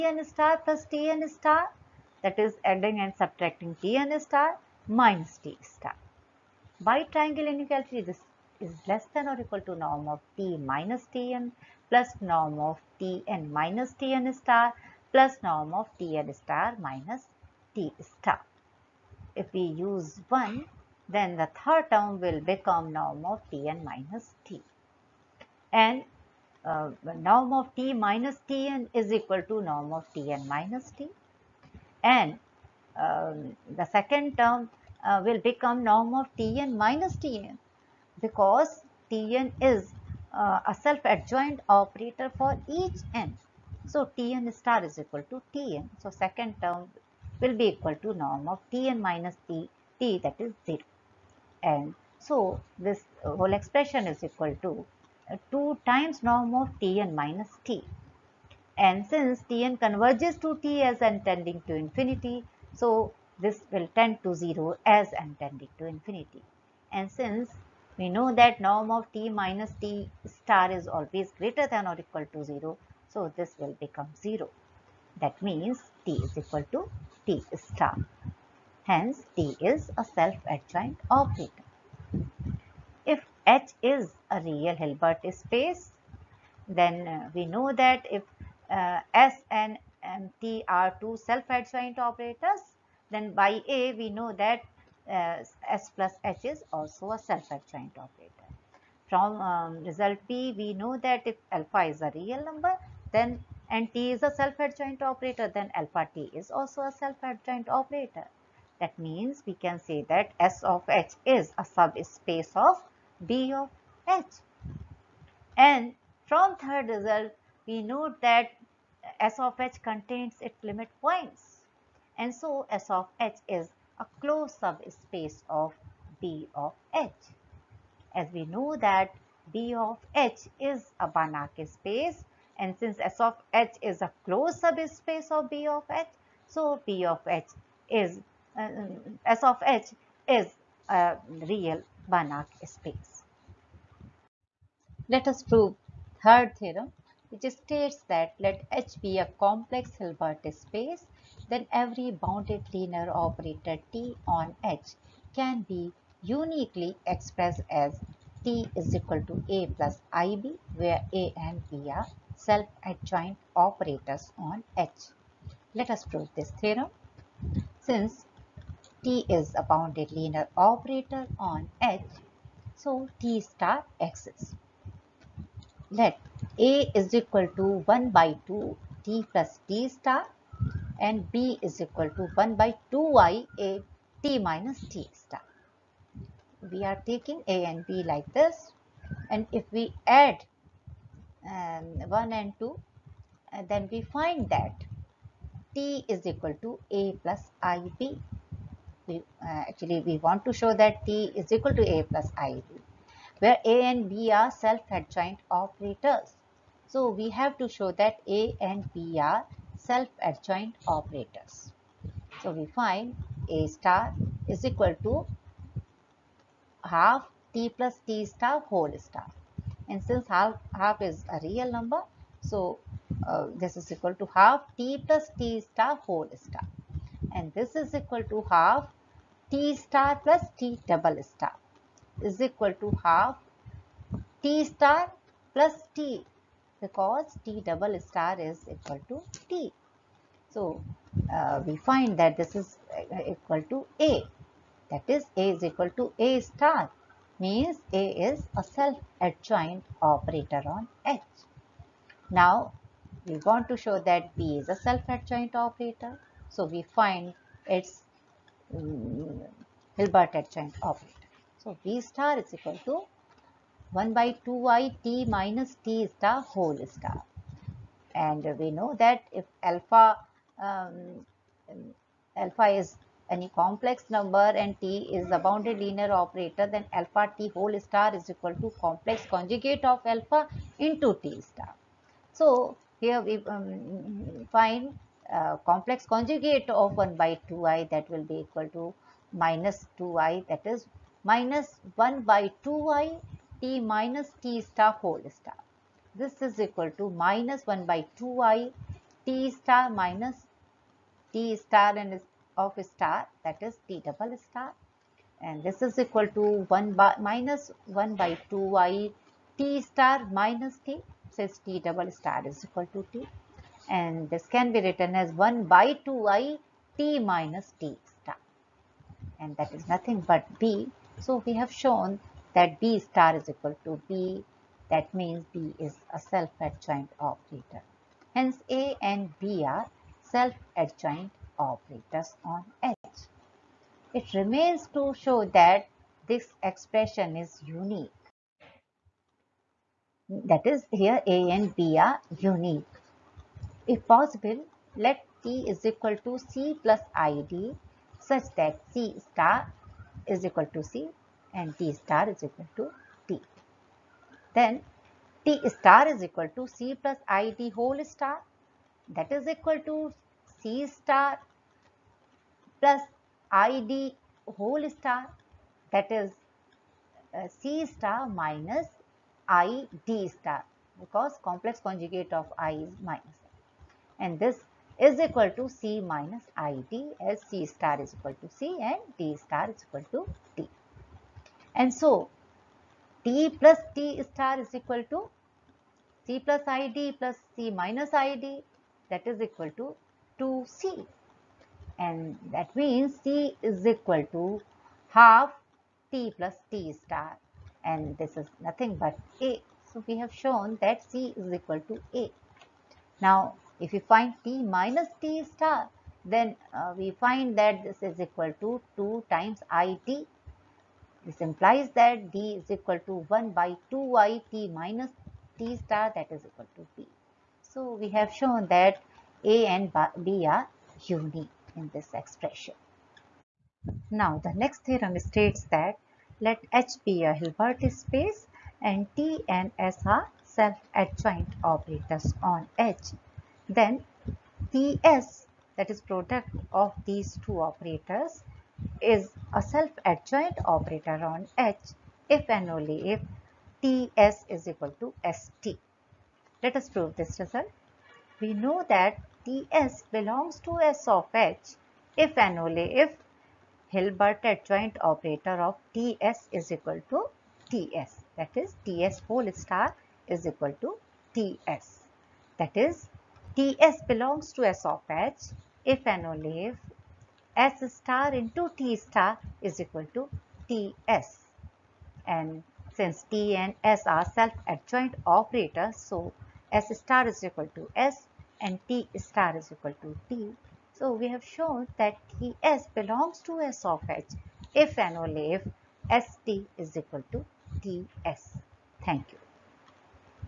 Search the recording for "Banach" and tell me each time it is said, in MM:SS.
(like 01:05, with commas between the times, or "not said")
02:11, 02:22.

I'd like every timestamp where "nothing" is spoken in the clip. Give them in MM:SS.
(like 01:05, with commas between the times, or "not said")
05:19, 06:38.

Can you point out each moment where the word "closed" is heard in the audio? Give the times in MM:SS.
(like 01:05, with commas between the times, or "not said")
02:04, 02:14.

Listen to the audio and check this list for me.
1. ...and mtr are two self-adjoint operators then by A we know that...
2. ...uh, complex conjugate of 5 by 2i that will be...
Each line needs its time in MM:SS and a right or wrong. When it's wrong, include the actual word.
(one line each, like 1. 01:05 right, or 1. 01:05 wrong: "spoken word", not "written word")
1. 01:29 right
2. 04:45 wrong: "1", not "5".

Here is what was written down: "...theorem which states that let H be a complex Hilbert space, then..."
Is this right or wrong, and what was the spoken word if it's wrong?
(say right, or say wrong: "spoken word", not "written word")
right.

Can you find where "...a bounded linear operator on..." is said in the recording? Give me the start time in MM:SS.
02:49.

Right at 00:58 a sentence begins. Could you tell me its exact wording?
And since Tn converges to T as and tending to infinity, so, this will tend to 0 as n tending to infinity.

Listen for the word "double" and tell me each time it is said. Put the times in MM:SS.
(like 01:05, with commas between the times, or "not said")
03:50, 03:57, 05:04, 05:11.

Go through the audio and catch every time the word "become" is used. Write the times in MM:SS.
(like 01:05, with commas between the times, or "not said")
00:22, 00:35, 01:13.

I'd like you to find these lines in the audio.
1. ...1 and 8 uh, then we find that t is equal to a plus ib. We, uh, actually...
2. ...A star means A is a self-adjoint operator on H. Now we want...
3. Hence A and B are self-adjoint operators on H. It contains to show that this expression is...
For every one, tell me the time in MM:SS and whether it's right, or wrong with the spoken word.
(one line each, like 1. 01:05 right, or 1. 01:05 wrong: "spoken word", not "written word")
1. 03:12 wrong: "2", not "8"
2. 04:06 right
3. 05:28 wrong: "remains", not "contains".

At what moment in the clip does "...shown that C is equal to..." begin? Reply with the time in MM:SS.
06:40.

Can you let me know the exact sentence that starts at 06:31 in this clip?
And that means C is equal to half T plus T star.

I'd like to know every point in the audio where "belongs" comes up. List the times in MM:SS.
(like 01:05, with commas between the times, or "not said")
07:30, 07:44, 08:02.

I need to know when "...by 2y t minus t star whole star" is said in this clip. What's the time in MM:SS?
04:24.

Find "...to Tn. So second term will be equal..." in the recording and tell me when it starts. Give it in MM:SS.
00:45.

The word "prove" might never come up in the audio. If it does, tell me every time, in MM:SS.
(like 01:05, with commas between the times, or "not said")
02:25, 02:46, 07:26.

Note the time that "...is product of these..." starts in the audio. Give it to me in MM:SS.
07:15.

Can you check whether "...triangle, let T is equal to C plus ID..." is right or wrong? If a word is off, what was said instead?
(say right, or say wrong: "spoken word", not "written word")
wrong: "possible", not "triangle".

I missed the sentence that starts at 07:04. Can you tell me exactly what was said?
Now the next theorem states that let H be a Hilbert space and T and S are self-adjoint operators on H.